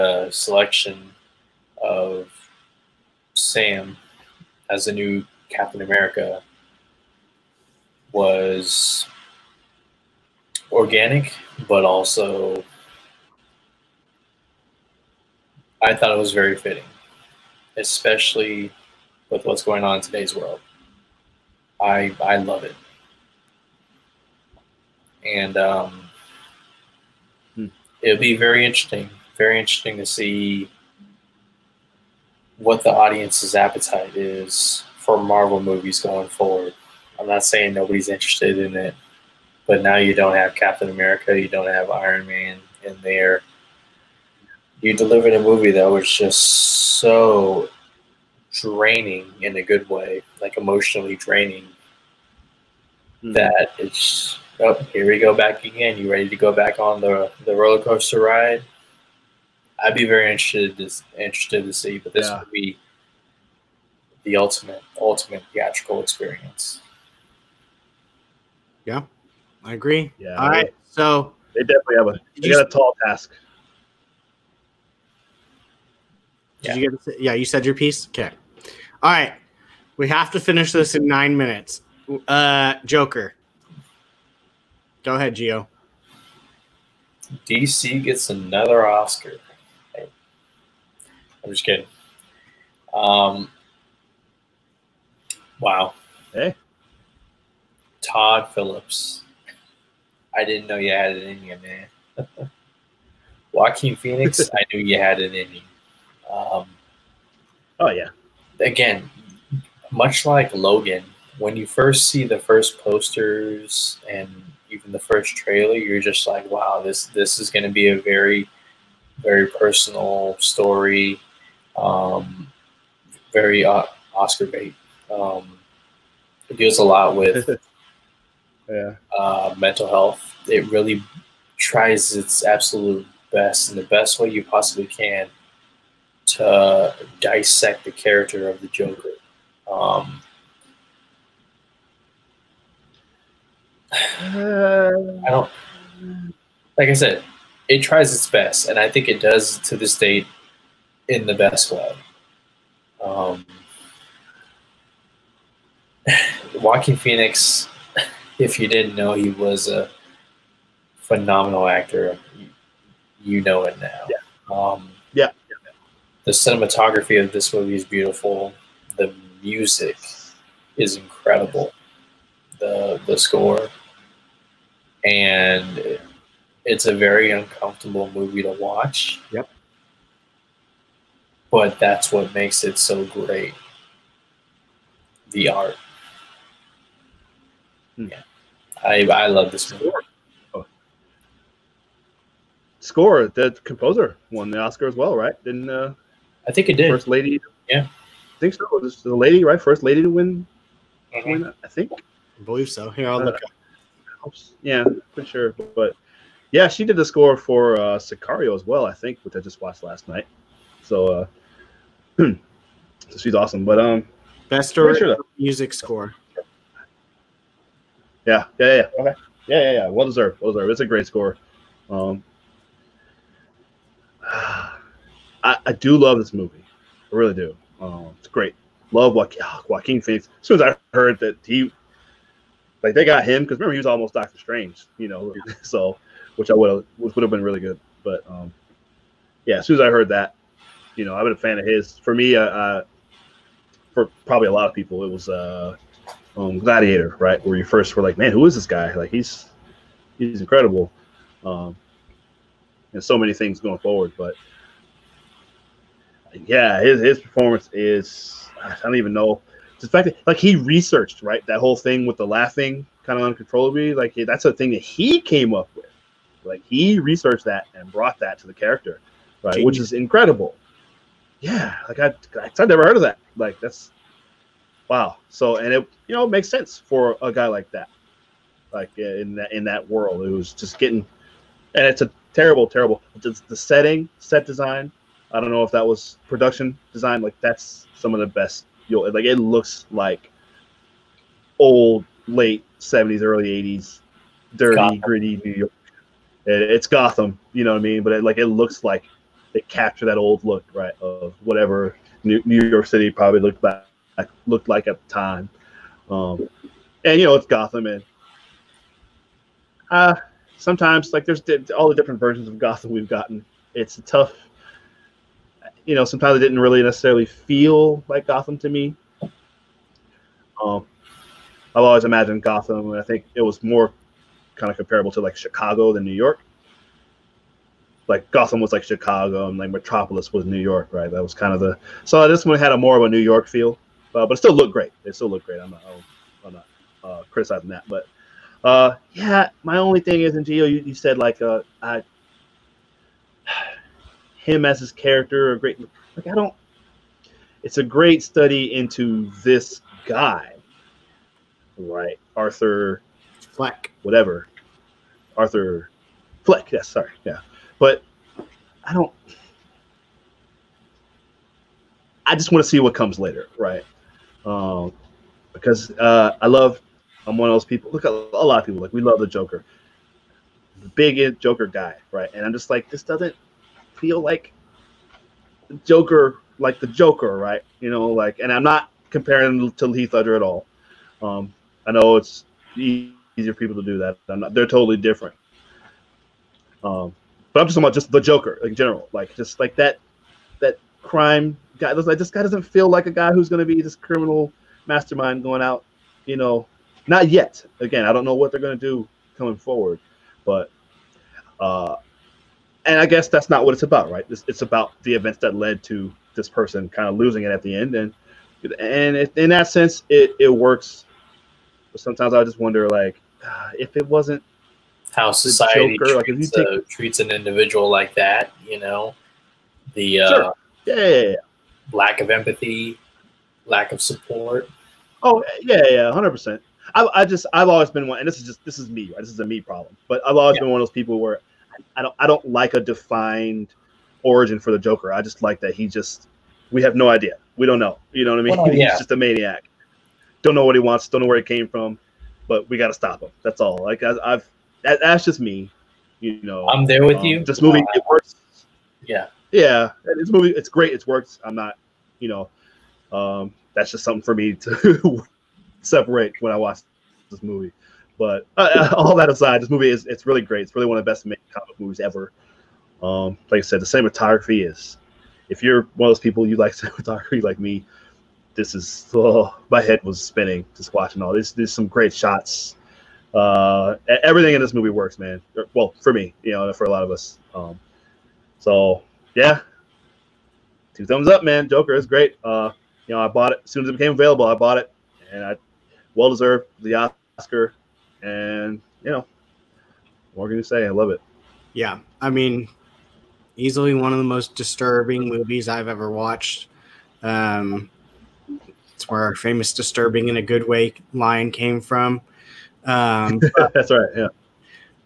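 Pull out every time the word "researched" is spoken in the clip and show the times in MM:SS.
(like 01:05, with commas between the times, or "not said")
04:20, 04:26.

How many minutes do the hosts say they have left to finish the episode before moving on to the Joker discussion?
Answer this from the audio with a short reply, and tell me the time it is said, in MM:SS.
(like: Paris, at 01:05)
9, at 01:21.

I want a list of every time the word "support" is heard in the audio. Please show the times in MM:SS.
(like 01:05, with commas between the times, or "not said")
07:04.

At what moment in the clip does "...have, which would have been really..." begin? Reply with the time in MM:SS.
03:56.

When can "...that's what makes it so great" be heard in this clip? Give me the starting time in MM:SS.
03:01.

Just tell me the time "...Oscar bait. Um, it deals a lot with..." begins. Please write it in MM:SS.
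02:04.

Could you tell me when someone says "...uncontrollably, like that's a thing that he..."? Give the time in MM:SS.
04:23.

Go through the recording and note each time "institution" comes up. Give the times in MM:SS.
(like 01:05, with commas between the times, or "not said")
not said.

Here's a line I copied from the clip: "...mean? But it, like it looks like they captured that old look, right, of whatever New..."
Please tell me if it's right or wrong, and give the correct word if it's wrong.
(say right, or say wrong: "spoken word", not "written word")
right.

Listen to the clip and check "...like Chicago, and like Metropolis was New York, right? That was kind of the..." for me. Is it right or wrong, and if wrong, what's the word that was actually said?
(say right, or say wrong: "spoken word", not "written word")
right.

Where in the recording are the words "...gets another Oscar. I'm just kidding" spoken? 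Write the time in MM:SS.
01:28.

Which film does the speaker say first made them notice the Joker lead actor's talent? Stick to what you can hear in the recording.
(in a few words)
Gladiator.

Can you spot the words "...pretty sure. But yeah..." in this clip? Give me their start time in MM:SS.
03:25.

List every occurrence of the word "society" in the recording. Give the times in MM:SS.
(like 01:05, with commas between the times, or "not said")
06:55.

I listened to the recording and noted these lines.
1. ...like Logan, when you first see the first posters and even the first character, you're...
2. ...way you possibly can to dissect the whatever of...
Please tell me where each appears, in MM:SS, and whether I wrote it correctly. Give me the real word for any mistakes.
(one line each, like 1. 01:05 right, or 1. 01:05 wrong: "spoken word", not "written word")
1. 01:50 wrong: "trailer", not "character"
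2. 02:14 wrong: "character", not "whatever".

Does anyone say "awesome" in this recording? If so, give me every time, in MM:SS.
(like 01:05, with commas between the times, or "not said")
03:33.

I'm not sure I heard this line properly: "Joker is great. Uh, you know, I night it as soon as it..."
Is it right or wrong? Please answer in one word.
wrong.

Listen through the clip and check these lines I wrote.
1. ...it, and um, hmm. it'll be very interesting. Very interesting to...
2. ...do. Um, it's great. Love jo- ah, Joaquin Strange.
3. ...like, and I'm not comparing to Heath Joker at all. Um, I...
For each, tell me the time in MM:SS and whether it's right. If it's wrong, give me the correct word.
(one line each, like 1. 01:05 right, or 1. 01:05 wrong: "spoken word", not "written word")
1. 00:22 right
2. 03:47 wrong: "Phoenix", not "Strange"
3. 06:18 wrong: "Ledger", not "Joker".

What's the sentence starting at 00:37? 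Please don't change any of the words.
I'm not saying nobody's interested in it, but now you don't have Captain America, you don't have Iron Man in there.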